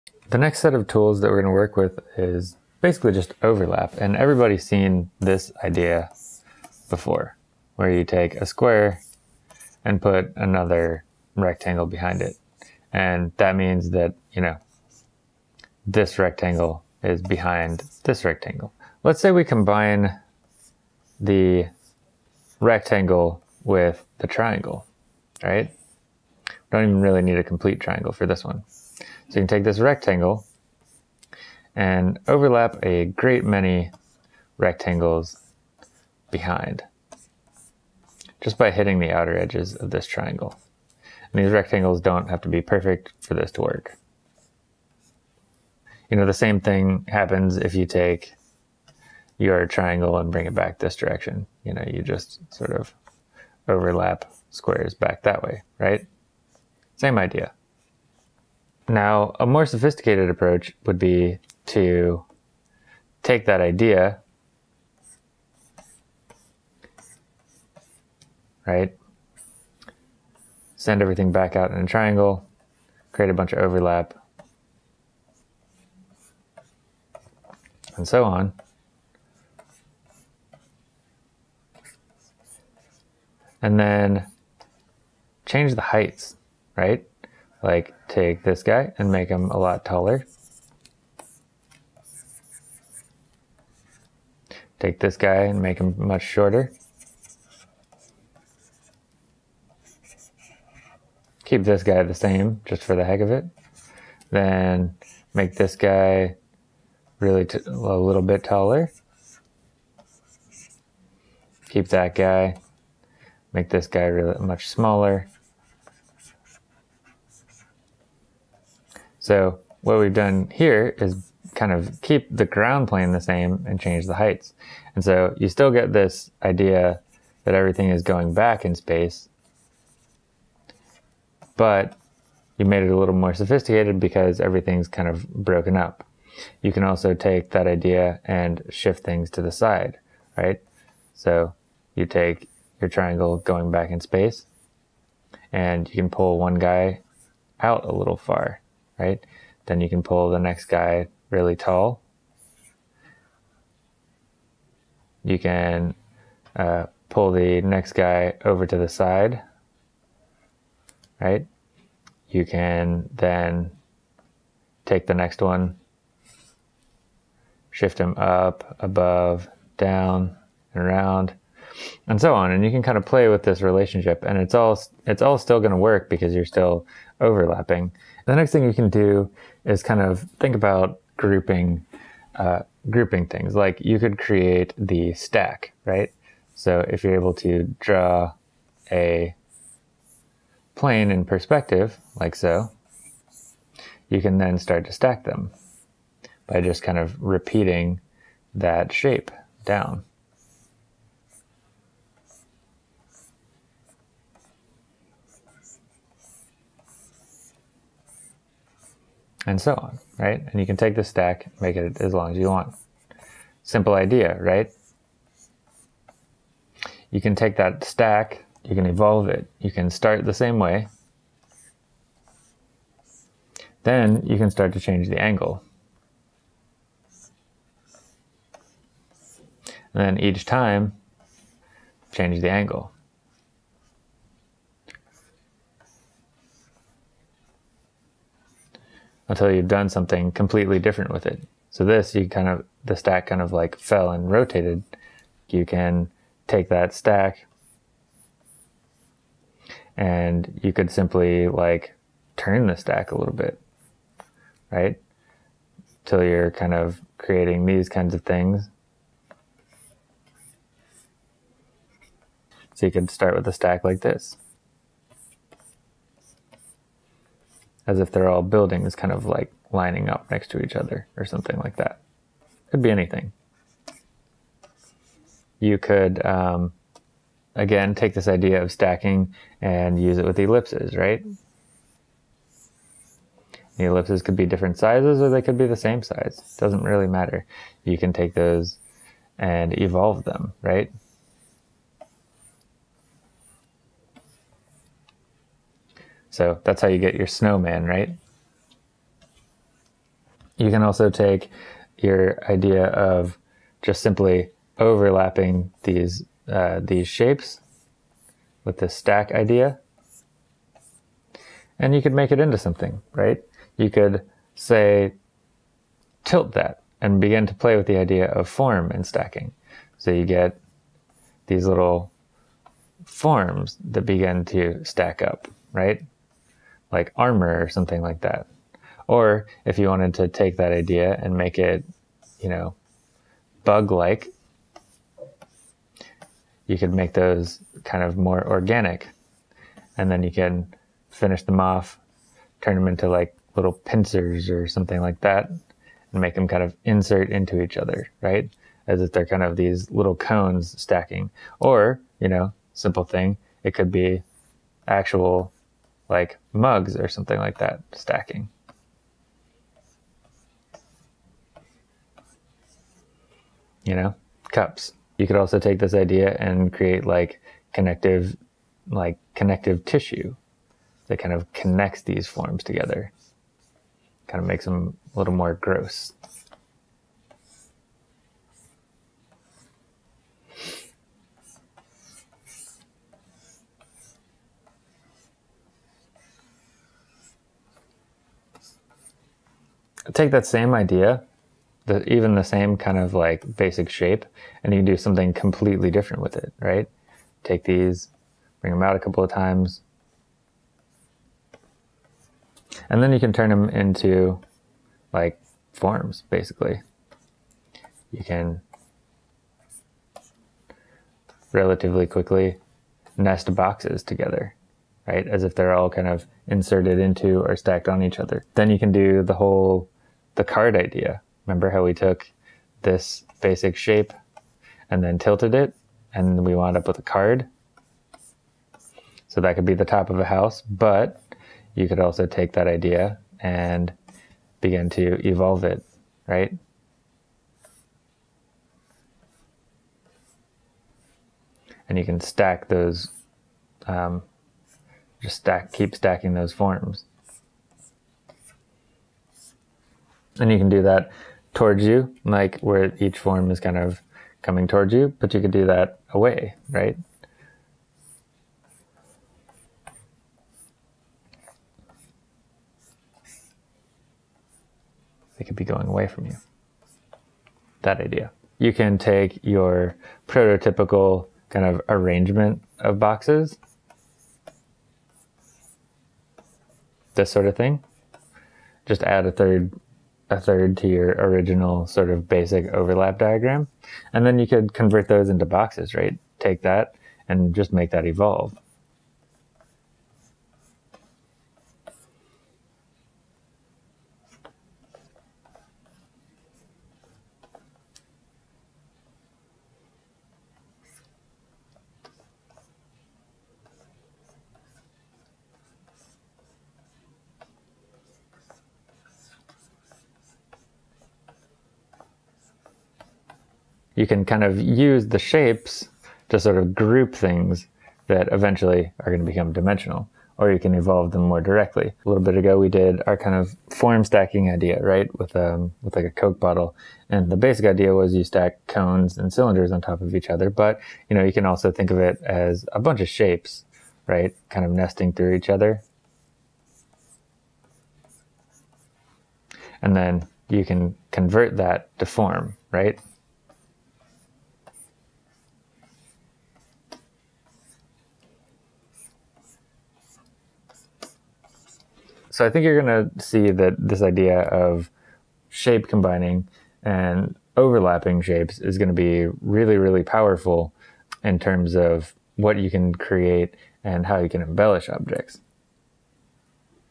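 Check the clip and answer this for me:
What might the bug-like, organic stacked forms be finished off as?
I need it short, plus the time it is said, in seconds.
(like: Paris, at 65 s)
pincers, at 343 s.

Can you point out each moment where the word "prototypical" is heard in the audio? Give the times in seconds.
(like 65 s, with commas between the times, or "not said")
470 s.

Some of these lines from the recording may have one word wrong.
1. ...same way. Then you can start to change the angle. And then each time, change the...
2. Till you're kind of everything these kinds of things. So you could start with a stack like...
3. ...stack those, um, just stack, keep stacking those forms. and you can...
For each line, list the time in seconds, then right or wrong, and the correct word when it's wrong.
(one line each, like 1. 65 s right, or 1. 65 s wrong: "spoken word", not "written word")
1. 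220 s right
2. 256 s wrong: "creating", not "everything"
3. 442 s right.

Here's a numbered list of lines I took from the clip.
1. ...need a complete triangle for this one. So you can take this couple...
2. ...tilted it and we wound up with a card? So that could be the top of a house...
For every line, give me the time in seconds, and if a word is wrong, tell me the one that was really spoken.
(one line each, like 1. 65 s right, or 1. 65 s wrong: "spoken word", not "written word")
1. 27 s wrong: "rectangle", not "couple"
2. 425 s right.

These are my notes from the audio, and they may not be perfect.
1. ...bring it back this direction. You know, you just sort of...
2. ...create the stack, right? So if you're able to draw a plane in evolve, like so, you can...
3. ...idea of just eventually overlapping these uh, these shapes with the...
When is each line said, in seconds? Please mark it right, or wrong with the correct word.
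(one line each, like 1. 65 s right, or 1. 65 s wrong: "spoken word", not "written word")
1. 50 s right
2. 184 s wrong: "perspective", not "evolve"
3. 302 s wrong: "simply", not "eventually".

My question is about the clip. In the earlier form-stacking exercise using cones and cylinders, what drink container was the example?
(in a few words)
Coke bottle.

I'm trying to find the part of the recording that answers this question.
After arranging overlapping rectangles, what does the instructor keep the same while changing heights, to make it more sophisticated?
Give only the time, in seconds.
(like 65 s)
122 s.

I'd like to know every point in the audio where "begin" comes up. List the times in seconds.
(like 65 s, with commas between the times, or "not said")
317 s, 324 s, 434 s.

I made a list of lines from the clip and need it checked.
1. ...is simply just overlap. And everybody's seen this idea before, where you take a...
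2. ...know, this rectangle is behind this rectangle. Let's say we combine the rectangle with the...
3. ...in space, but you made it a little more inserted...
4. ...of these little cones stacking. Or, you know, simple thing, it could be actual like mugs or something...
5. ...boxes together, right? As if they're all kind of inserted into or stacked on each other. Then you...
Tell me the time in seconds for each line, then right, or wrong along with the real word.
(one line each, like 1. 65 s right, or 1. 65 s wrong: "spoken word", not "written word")
1. 2 s wrong: "basically", not "simply"
2. 14 s right
3. 128 s wrong: "sophisticated", not "inserted"
4. 349 s right
5. 413 s right.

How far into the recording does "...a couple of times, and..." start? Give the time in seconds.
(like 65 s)
398 s.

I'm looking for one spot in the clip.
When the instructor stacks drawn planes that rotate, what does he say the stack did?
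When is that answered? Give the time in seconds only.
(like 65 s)
243 s.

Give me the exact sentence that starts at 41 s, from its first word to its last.
And these rectangles don't have to be perfect for this to work.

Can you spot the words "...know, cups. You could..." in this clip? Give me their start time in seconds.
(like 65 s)
363 s.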